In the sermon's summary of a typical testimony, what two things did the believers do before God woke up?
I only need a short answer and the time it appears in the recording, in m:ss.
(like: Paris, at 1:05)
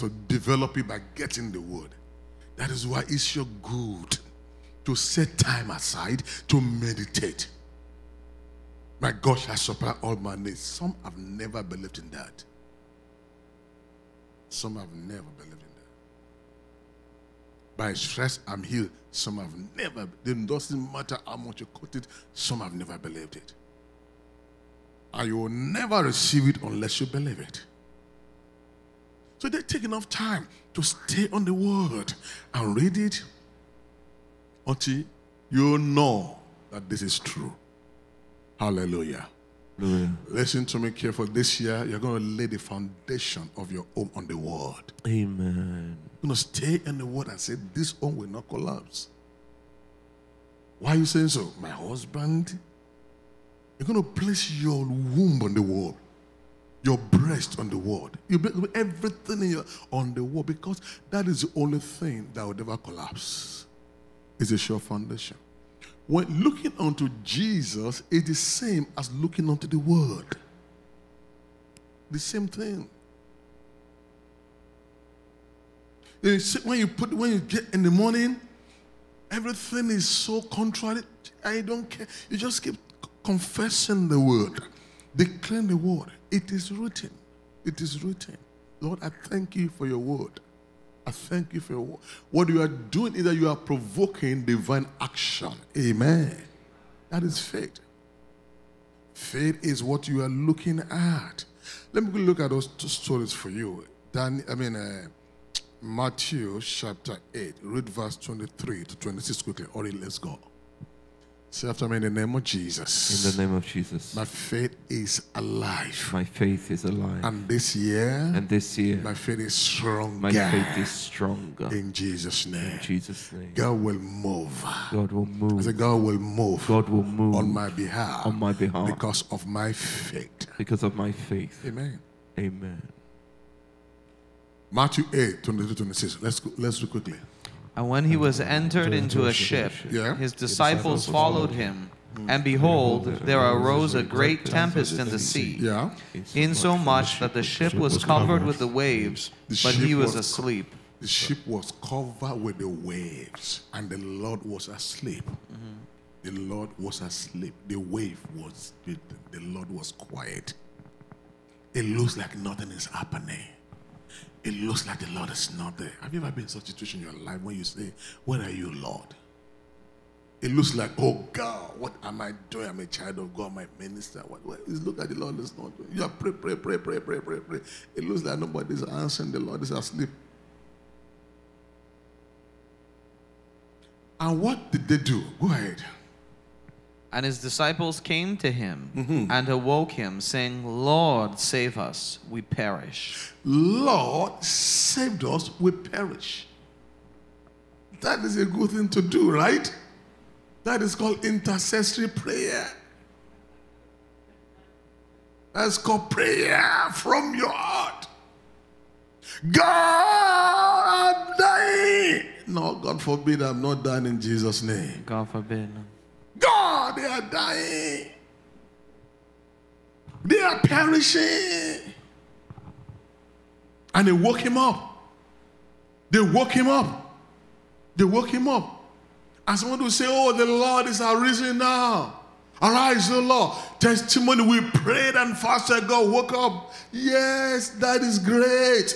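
Prayed and fasted, at 3:54.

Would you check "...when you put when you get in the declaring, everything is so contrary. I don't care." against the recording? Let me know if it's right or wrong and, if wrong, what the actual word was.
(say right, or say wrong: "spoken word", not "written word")
wrong: "morning", not "declaring".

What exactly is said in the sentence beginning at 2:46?
Have you ever been in such a situation in your life when you say, Where are you, Lord?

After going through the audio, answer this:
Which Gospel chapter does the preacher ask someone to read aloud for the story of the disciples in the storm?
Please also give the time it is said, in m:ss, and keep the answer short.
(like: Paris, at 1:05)
Matthew chapter 8, at 1:45.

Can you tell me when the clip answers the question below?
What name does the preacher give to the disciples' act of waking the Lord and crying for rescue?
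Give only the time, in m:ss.
3:21.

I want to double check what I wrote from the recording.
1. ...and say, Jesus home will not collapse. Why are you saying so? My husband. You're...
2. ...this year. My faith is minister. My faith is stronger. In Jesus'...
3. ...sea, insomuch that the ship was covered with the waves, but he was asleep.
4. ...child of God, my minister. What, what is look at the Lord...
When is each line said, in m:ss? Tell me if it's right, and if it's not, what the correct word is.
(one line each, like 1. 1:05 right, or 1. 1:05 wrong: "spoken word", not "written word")
1. 0:47 wrong: "This", not "Jesus"
2. 1:58 wrong: "stronger", not "minister"
3. 2:25 right
4. 2:52 right.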